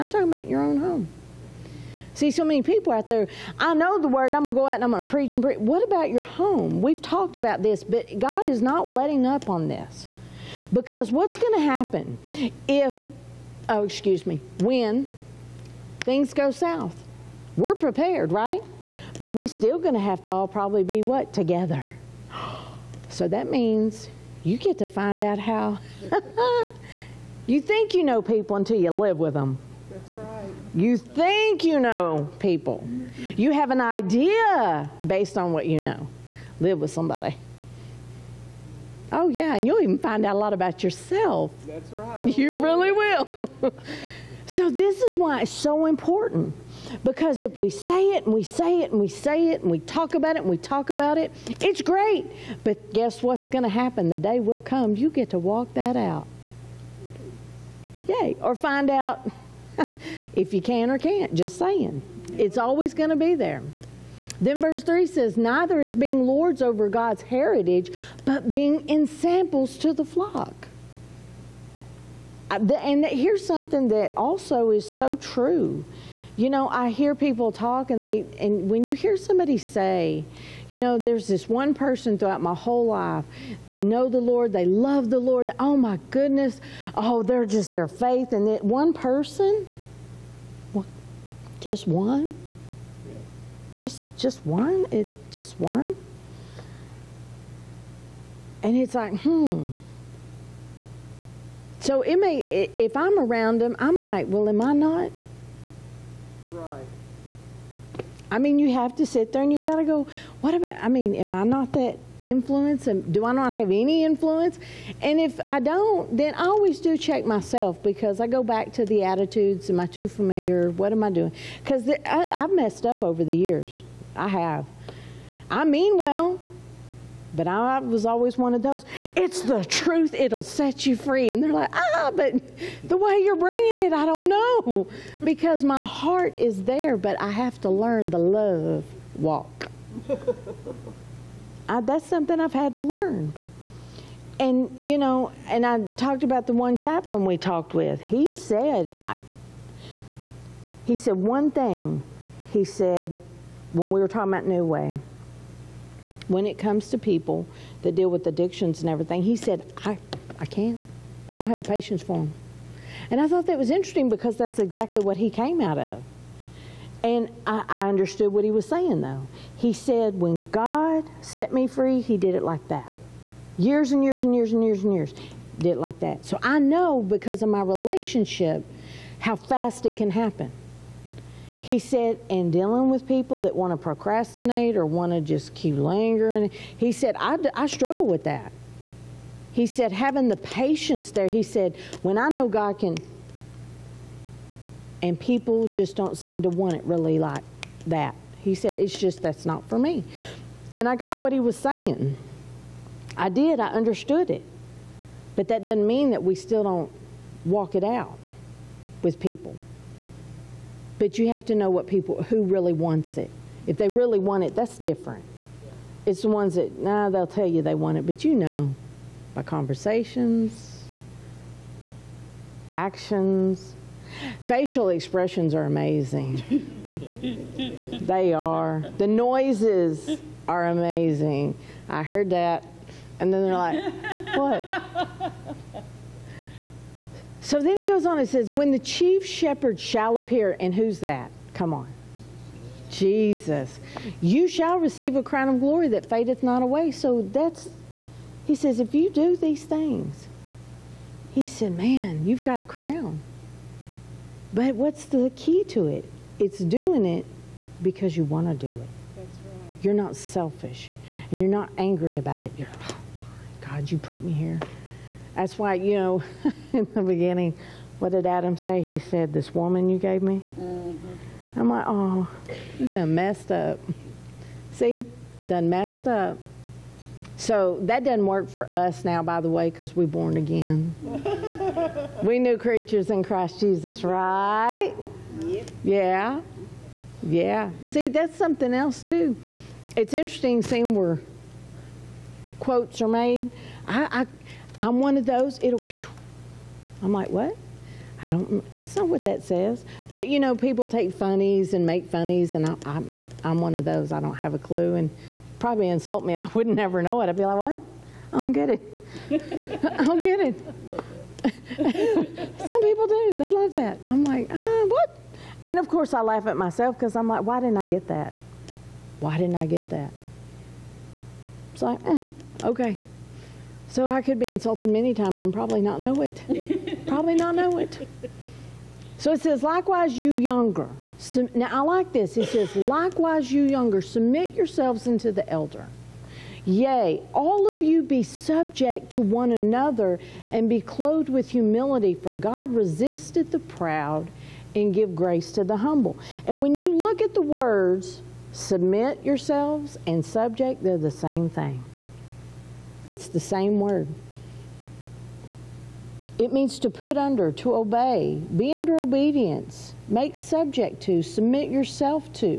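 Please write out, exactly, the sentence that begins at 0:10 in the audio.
Because what's going to happen if, oh, excuse me, when things go south?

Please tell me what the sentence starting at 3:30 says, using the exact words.
But you have to know what people who really wants it.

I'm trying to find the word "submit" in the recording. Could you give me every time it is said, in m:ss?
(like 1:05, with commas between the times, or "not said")
5:34, 5:48, 6:01.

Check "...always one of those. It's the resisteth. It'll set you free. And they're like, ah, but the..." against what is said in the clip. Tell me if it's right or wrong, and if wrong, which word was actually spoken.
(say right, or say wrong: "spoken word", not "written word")
wrong: "truth", not "resisteth".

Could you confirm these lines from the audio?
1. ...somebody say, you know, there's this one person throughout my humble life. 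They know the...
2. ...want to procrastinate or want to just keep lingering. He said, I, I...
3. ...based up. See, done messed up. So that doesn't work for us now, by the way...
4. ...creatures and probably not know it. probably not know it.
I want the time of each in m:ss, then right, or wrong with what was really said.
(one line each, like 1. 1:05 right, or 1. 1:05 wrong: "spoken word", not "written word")
1. 1:19 wrong: "whole", not "humble"
2. 3:03 right
3. 4:33 wrong: "messed", not "based"
4. 5:25 wrong: "times", not "creatures".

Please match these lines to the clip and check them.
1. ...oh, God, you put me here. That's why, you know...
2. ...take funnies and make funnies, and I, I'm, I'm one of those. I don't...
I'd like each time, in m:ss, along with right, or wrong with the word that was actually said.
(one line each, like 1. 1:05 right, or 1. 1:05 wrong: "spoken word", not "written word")
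1. 4:22 right
2. 5:00 right.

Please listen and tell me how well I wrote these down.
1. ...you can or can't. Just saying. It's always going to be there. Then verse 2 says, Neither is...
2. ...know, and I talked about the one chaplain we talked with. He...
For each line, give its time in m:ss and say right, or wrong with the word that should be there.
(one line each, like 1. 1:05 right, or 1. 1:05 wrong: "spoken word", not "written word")
1. 1:00 wrong: "3", not "2"
2. 2:24 right.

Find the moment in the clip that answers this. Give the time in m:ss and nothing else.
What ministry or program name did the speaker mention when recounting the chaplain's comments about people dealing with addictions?
2:34.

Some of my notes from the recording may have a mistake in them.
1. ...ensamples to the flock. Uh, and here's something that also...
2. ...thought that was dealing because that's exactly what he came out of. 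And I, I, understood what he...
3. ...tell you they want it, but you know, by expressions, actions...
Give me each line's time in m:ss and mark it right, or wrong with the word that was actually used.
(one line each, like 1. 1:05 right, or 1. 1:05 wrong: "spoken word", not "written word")
1. 1:08 right
2. 2:43 wrong: "interesting", not "dealing"
3. 3:37 wrong: "conversations", not "expressions".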